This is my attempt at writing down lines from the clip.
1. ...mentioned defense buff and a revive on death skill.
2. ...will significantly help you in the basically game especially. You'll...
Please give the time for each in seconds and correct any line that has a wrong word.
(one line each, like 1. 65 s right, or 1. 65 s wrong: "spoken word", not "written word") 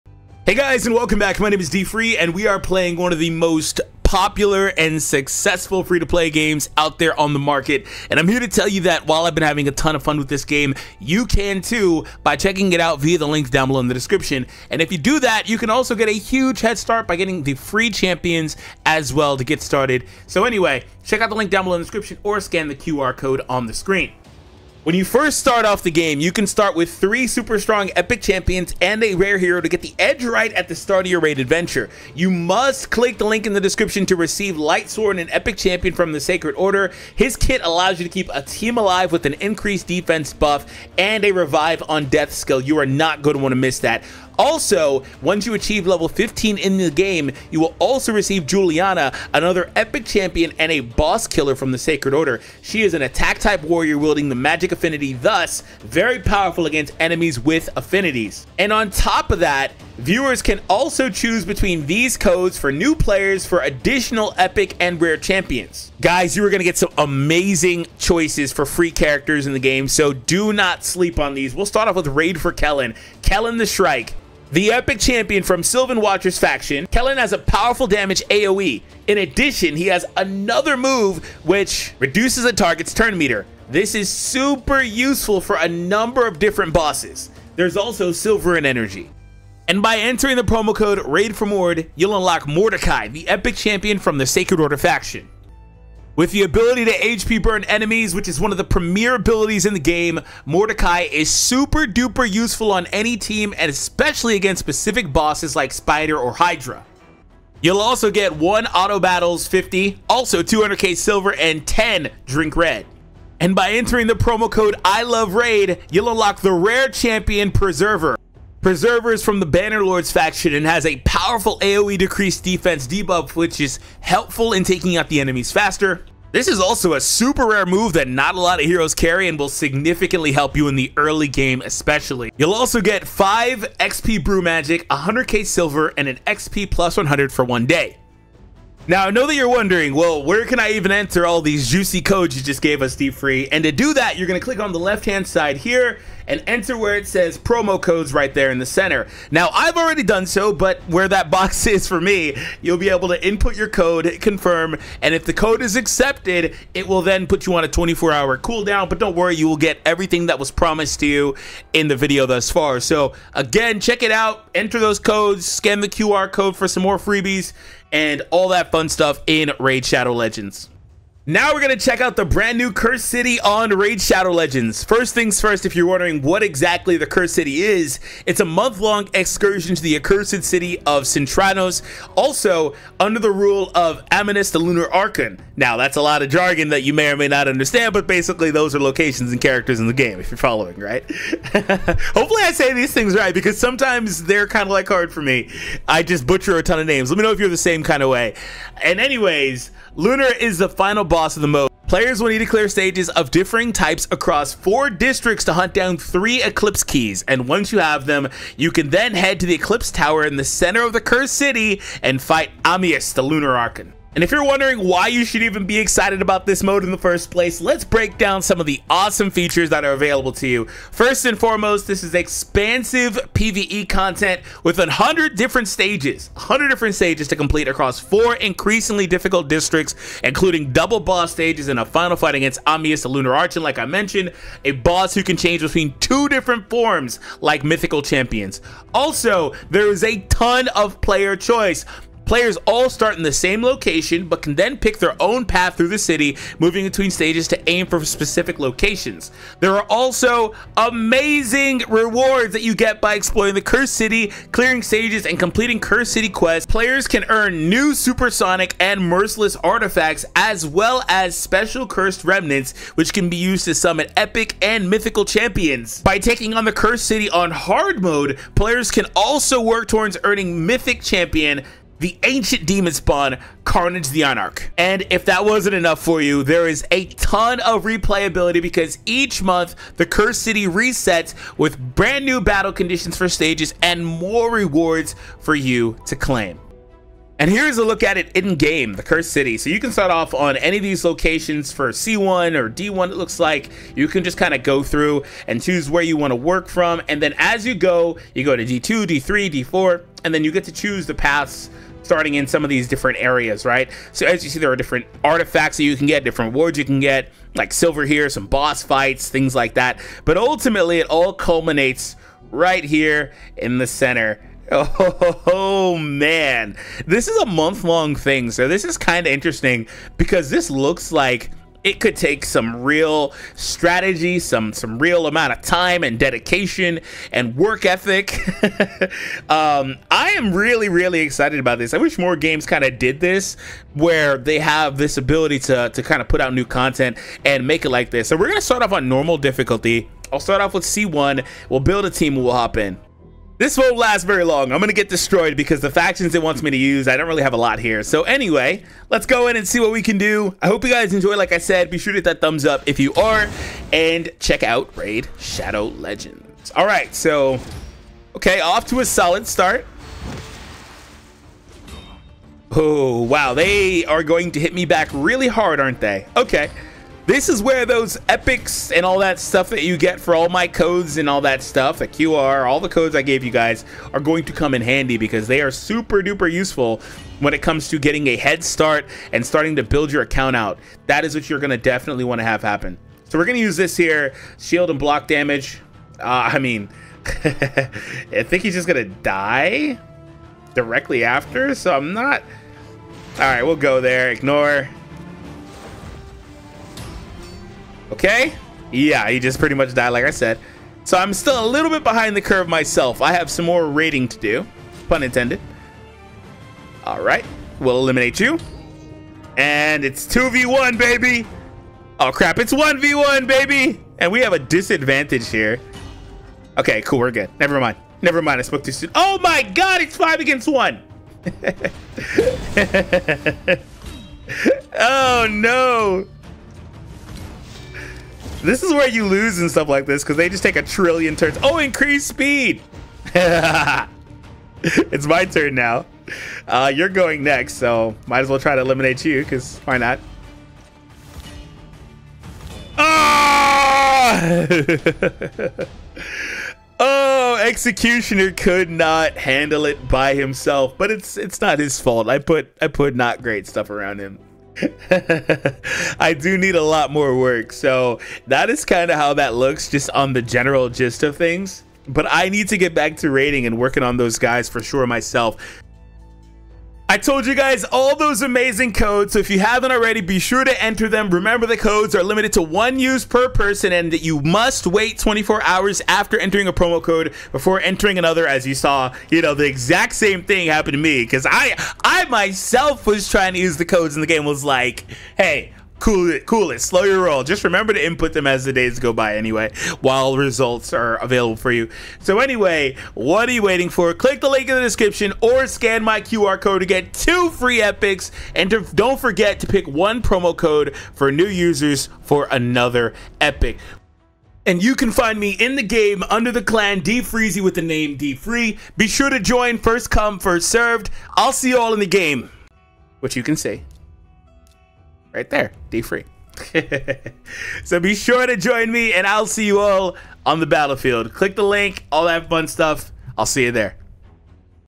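1. 39 s wrong: "increased", not "mentioned"
2. 129 s wrong: "early", not "basically".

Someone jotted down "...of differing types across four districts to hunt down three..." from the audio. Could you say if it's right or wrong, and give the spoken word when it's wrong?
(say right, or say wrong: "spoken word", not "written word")
right.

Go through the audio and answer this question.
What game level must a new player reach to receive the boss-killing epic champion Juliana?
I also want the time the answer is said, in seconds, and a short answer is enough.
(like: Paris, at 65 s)
15, at 45 s.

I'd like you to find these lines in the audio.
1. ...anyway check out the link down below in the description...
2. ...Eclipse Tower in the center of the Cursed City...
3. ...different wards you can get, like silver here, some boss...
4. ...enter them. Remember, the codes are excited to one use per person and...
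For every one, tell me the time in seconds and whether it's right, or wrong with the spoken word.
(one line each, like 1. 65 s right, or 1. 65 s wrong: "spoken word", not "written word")
1. 20 s right
2. 209 s right
3. 306 s right
4. 470 s wrong: "limited", not "excited".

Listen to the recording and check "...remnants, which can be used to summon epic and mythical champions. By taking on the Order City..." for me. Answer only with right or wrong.
wrong.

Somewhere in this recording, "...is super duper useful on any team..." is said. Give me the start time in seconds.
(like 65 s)
101 s.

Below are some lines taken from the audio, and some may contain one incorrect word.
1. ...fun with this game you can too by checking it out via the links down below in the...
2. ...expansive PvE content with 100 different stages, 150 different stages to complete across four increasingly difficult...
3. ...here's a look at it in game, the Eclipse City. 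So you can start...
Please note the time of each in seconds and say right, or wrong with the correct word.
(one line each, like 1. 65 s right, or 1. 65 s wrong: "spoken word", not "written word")
1. 10 s right
2. 222 s wrong: "100", not "150"
3. 287 s wrong: "Cursed", not "Eclipse".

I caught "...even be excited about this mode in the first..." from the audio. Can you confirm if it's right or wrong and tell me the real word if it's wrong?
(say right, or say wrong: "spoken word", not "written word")
right.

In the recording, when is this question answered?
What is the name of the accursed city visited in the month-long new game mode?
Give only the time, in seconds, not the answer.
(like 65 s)
181 s.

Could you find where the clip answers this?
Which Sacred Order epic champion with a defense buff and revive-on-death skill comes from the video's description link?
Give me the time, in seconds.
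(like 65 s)
34 s.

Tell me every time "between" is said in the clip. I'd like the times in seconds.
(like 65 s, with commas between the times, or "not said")
61 s, 235 s, 246 s.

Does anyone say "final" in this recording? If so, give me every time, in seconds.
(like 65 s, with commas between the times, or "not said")
200 s, 231 s.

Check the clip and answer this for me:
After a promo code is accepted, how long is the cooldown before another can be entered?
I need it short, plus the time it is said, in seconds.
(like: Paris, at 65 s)
24 hours, at 157 s.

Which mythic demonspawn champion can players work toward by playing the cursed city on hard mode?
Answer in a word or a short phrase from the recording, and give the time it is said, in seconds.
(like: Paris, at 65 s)
Carnage the Anarch, at 273 s.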